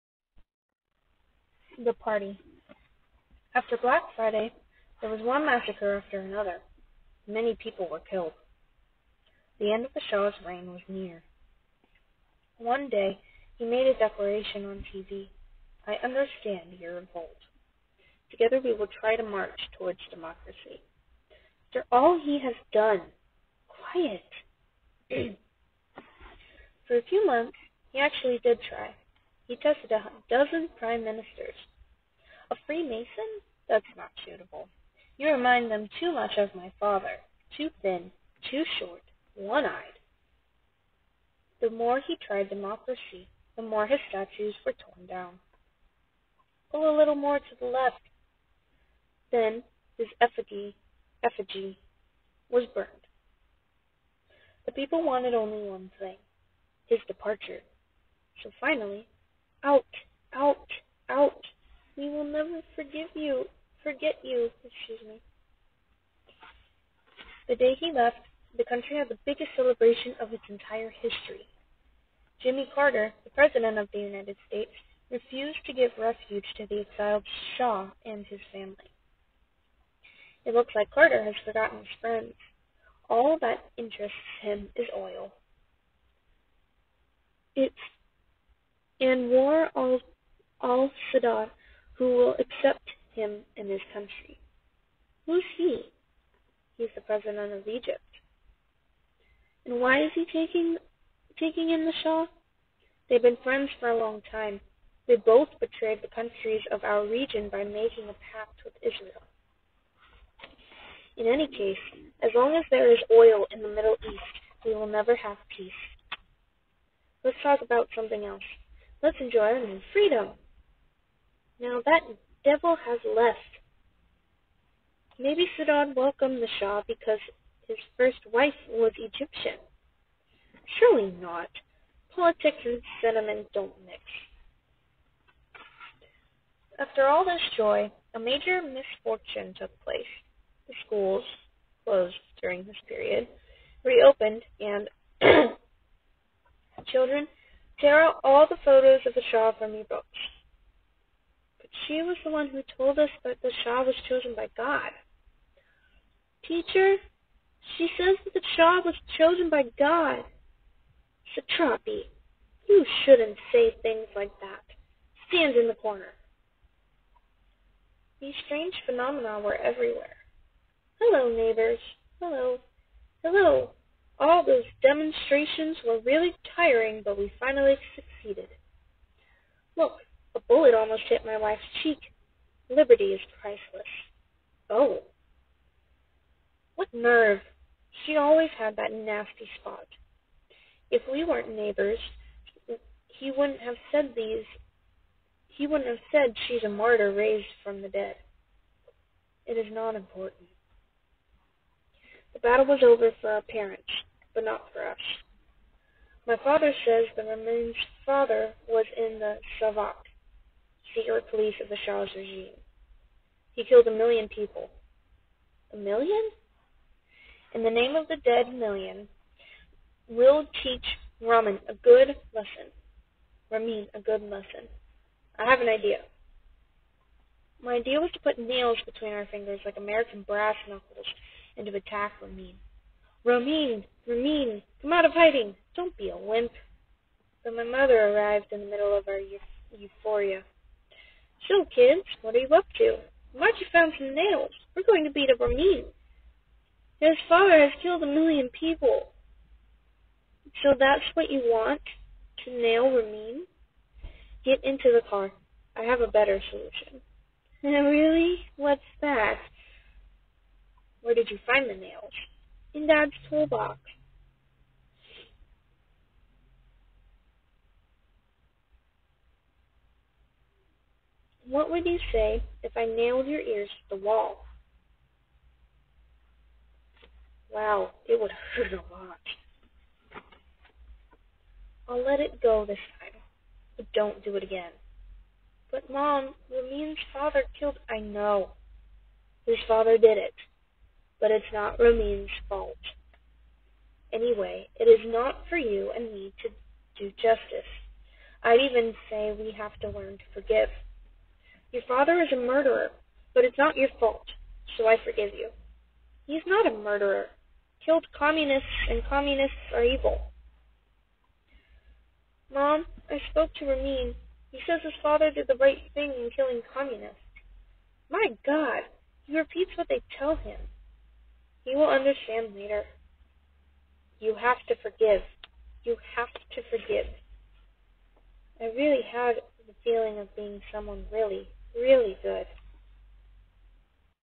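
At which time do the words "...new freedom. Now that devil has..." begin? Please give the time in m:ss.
1:59.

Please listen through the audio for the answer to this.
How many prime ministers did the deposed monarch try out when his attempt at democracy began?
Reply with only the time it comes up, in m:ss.
0:29.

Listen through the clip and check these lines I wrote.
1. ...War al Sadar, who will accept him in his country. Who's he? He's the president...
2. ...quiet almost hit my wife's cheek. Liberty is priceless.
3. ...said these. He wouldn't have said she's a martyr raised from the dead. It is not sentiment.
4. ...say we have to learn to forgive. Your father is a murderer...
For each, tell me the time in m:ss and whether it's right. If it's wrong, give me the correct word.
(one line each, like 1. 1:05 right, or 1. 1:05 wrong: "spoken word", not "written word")
1. 1:29 right
2. 3:00 wrong: "bullet", not "quiet"
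3. 3:13 wrong: "important", not "sentiment"
4. 4:59 right.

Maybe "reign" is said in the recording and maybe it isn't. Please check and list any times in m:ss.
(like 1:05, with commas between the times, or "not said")
0:10.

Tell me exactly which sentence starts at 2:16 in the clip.
After all this joy, a major misfortune took place.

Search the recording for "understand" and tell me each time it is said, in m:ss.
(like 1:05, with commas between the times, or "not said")
0:16, 5:21.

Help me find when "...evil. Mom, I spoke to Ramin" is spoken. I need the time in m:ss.
5:09.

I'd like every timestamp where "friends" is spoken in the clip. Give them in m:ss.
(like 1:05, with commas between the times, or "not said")
1:21, 1:43.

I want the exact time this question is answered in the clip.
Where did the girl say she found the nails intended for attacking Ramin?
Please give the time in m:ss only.
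4:22.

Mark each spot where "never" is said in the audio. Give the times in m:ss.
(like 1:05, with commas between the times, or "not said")
1:02, 1:54.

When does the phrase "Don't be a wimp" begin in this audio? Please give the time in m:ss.
3:55.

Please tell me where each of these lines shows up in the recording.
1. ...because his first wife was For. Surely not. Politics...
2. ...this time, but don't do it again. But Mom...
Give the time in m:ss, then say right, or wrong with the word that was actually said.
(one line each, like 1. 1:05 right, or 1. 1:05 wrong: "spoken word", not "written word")
1. 2:06 wrong: "Egyptian", not "For"
2. 4:42 right.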